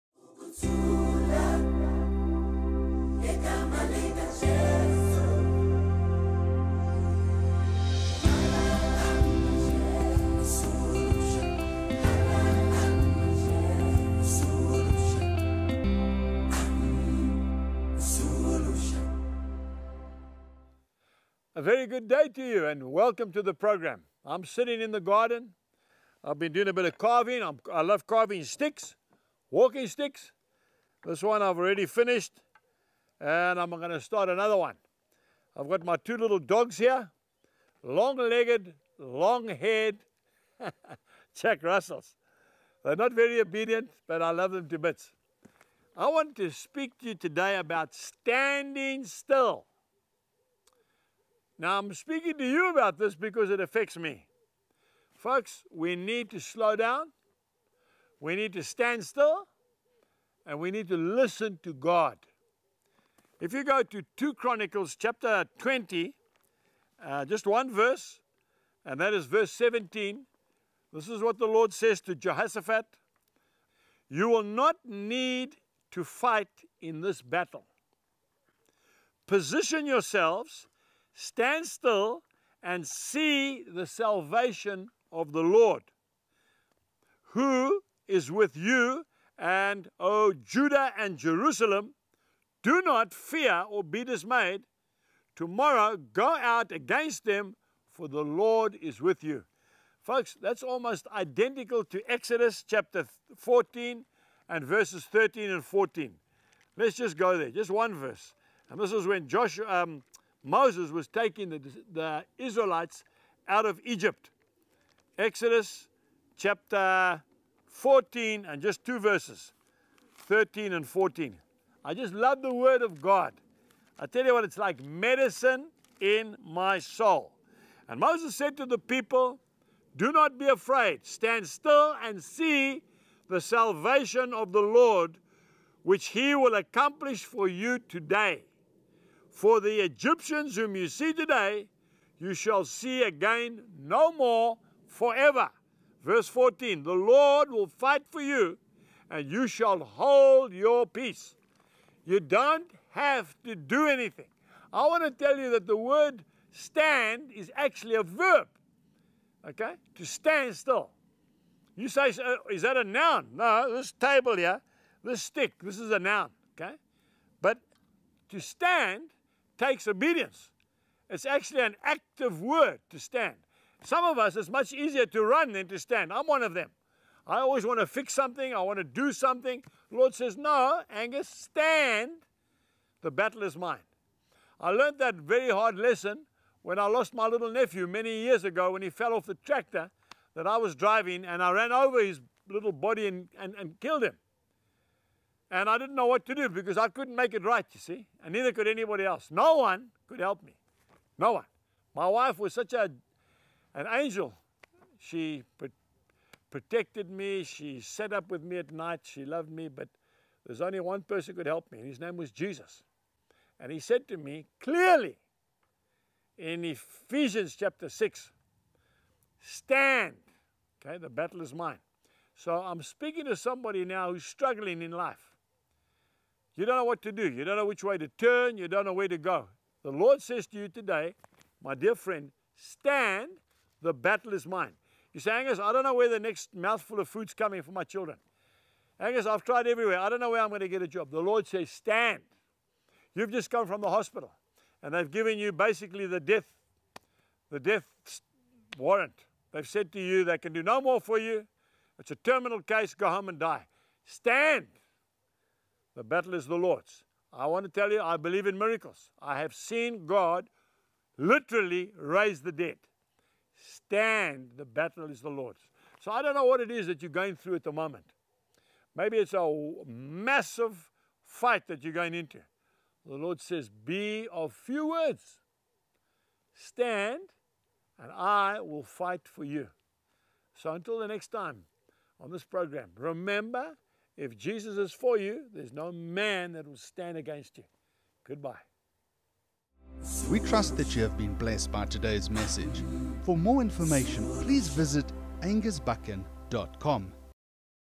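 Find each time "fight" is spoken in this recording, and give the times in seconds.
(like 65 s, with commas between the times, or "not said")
76 s, 147 s, 271 s, 278 s.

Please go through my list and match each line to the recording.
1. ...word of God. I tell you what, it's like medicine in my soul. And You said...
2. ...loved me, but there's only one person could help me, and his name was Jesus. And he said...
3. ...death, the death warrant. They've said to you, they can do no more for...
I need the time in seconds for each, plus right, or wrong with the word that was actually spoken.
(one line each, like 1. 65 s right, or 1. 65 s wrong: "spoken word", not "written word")
1. 122 s wrong: "Moses", not "You"
2. 209 s right
3. 246 s right.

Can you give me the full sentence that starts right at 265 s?
So I don't know what it is that you're going through at the moment.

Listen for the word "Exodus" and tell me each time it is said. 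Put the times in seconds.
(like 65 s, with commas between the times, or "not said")
102 s, 115 s.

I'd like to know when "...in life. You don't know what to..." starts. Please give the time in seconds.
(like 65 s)
224 s.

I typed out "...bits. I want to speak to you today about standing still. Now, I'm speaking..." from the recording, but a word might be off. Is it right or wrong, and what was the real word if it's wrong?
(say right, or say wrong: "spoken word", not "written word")
right.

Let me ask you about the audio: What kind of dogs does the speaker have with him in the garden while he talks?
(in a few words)
Jack Russells.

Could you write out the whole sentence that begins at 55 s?
Folks, we need to slow down.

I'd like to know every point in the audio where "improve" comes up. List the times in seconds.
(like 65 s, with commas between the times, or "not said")
not said.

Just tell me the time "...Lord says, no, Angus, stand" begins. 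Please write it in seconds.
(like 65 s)
179 s.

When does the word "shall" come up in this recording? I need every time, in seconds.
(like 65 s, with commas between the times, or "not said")
142 s, 149 s.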